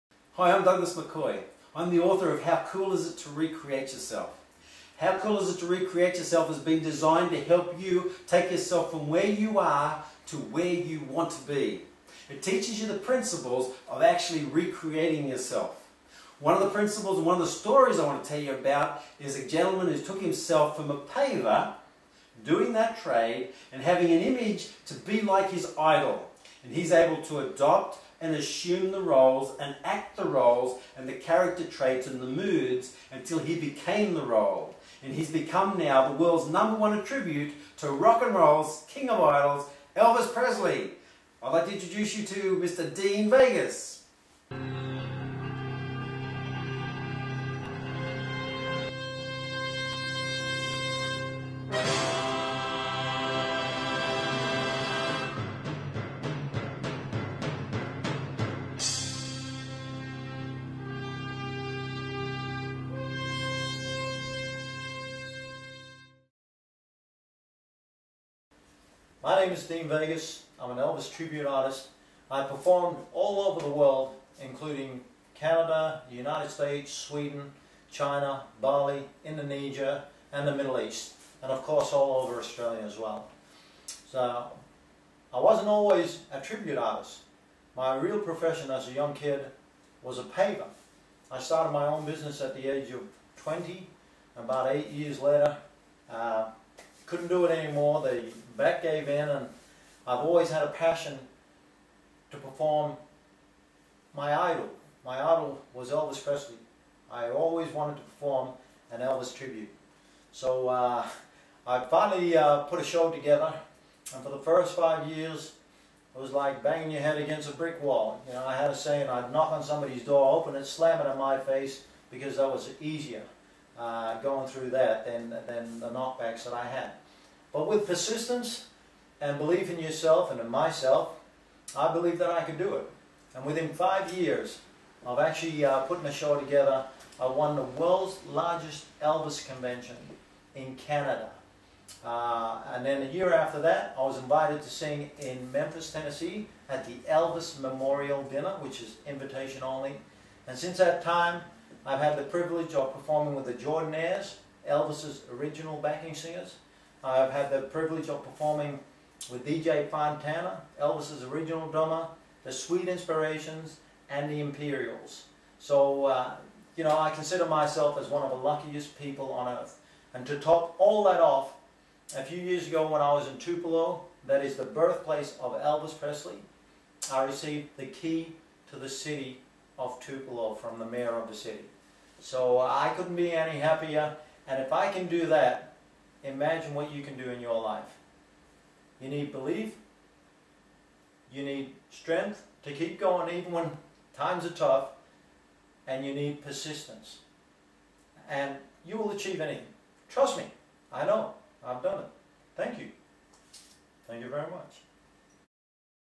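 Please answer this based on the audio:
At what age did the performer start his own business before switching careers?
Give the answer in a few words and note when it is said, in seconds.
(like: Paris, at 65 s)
20, at 93 s.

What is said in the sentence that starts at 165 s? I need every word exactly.
So, uh, you know, I consider myself as one of the luckiest people on earth.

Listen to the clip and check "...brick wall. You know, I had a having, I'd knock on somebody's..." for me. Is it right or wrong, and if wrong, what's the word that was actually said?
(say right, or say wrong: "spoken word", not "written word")
wrong: "saying", not "having".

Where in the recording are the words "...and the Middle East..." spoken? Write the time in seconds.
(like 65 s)
80 s.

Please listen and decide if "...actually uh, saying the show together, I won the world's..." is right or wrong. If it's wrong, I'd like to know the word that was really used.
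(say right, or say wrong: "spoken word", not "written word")
wrong: "putting", not "saying".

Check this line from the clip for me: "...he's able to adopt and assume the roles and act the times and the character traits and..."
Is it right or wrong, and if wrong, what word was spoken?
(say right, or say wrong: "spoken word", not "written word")
wrong: "roles", not "times".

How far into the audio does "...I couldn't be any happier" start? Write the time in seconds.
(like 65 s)
182 s.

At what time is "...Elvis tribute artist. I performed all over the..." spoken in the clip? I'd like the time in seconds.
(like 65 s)
70 s.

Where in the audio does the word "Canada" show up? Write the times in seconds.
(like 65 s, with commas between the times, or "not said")
75 s, 140 s.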